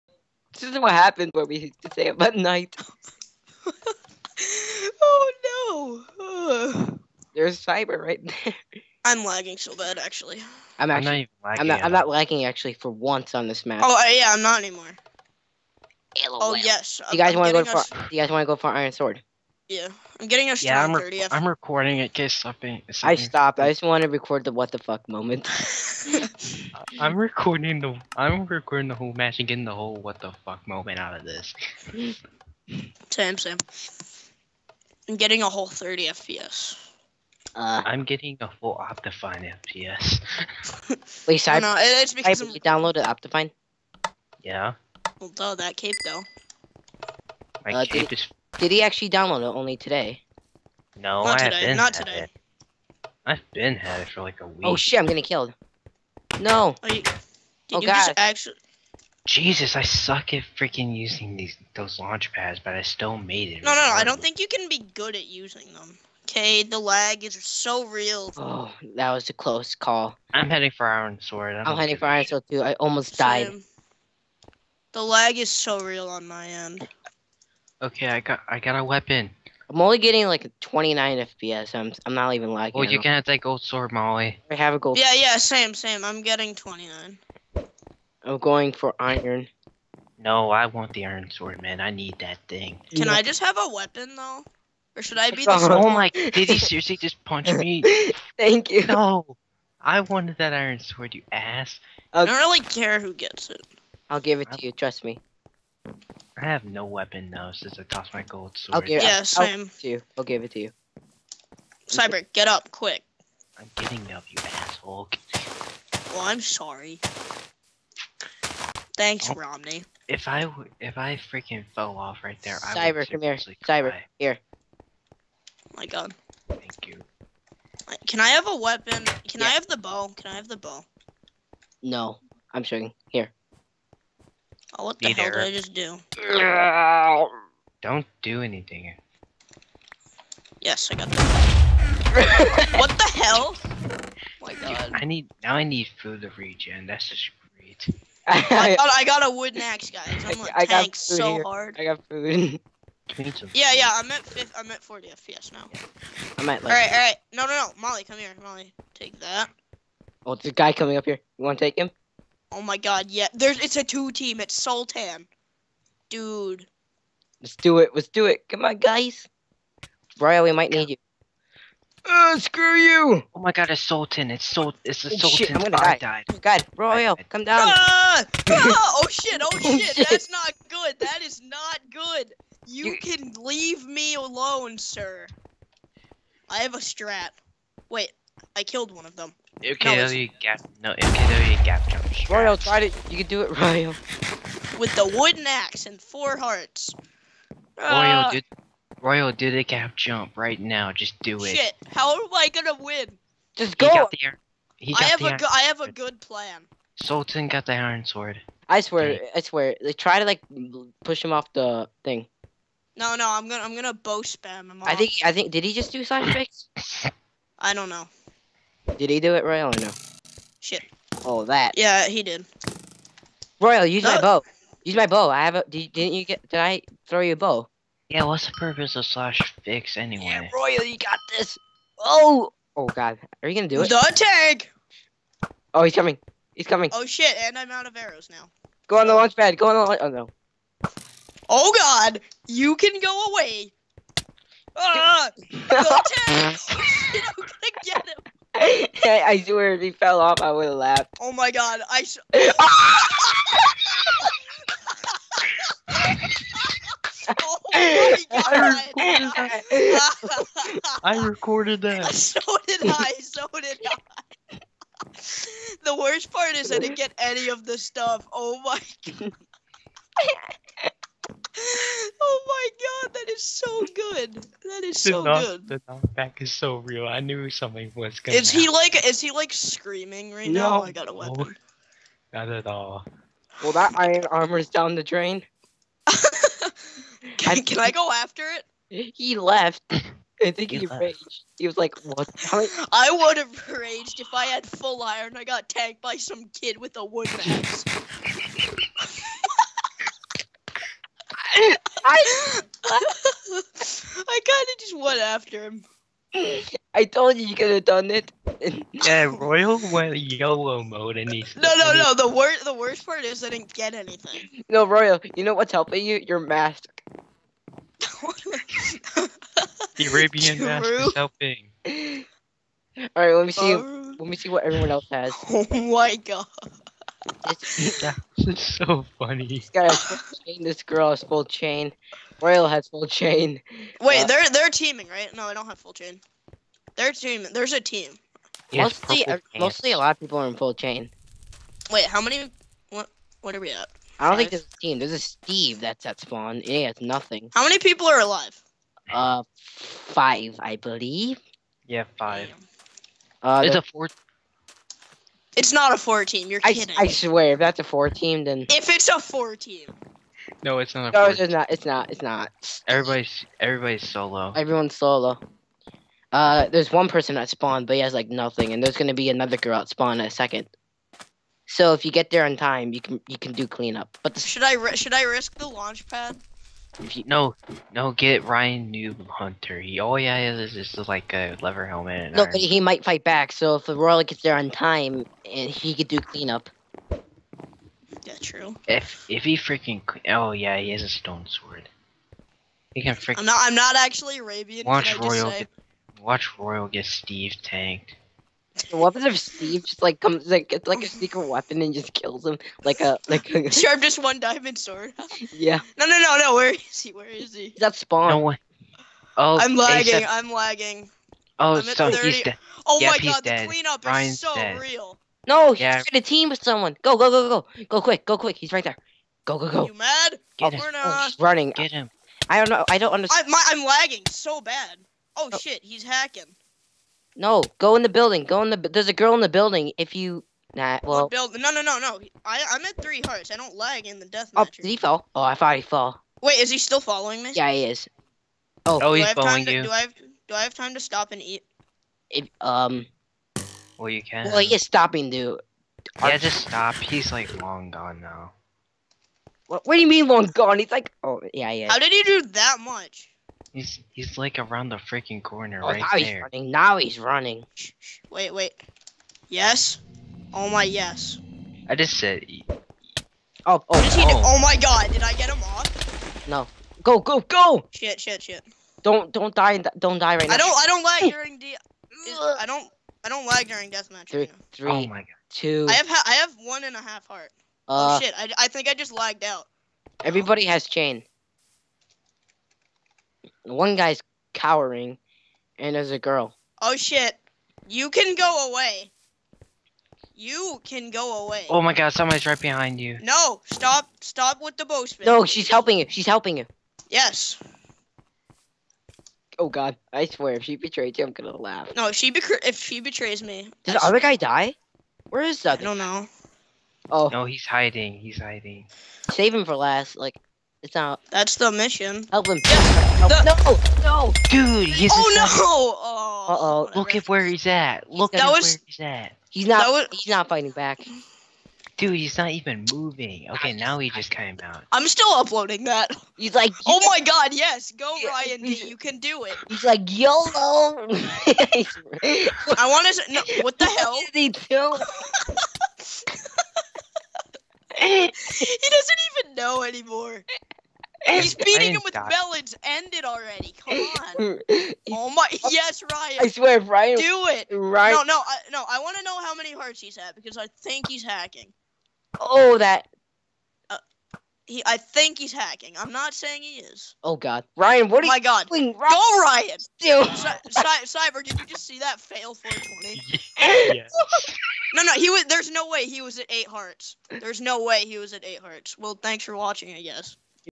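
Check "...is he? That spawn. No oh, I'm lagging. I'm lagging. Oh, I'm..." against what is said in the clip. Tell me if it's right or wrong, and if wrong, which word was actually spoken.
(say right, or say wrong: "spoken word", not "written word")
right.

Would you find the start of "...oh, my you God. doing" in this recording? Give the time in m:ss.
9:18.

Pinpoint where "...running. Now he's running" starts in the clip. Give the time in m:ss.
7:36.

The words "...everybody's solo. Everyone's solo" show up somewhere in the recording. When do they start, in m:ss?
6:03.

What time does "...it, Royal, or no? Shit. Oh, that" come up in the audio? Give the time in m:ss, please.
3:39.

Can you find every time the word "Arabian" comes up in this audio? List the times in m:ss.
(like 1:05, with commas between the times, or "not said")
5:20, 6:34.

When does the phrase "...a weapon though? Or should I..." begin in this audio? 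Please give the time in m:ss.
1:33.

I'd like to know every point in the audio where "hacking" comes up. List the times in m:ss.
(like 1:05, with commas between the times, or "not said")
7:06, 9:11, 9:15.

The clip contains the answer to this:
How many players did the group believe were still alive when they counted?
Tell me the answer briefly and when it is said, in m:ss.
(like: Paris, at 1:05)
5, at 5:49.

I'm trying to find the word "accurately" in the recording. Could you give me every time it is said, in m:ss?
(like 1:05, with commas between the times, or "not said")
not said.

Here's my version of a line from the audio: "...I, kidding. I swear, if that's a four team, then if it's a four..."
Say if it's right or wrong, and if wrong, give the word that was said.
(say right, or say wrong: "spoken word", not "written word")
right.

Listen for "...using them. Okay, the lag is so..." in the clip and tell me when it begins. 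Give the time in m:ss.
1:05.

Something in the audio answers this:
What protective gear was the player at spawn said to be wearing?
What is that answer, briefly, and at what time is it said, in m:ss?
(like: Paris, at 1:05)
leather helmet, at 6:21.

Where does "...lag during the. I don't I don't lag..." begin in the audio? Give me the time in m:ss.
7:51.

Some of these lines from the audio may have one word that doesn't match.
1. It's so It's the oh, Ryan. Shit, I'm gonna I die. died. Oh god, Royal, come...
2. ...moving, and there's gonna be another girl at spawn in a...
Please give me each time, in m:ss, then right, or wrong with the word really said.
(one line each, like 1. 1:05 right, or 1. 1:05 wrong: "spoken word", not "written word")
1. 2:54 wrong: "Sultan", not "Ryan"
2. 6:08 wrong: "nothing", not "moving".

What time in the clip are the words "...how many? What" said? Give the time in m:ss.
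5:42.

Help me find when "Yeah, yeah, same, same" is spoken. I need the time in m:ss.
1:24.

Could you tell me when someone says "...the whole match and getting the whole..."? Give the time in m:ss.
0:28.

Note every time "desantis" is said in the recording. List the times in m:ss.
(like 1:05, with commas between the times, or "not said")
not said.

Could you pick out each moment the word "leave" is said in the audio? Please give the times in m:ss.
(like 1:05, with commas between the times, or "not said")
3:03.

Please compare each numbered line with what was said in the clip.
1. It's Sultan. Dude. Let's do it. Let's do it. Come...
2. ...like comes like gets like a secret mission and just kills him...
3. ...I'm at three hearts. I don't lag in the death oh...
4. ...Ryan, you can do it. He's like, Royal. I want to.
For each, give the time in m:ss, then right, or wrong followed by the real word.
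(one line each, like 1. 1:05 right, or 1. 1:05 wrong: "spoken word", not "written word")
1. 2:44 right
2. 6:40 wrong: "weapon", not "mission"
3. 7:12 right
4. 8:48 wrong: "YOLO", not "Royal".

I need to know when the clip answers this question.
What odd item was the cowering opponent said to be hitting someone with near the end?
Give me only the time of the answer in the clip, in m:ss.
9:02.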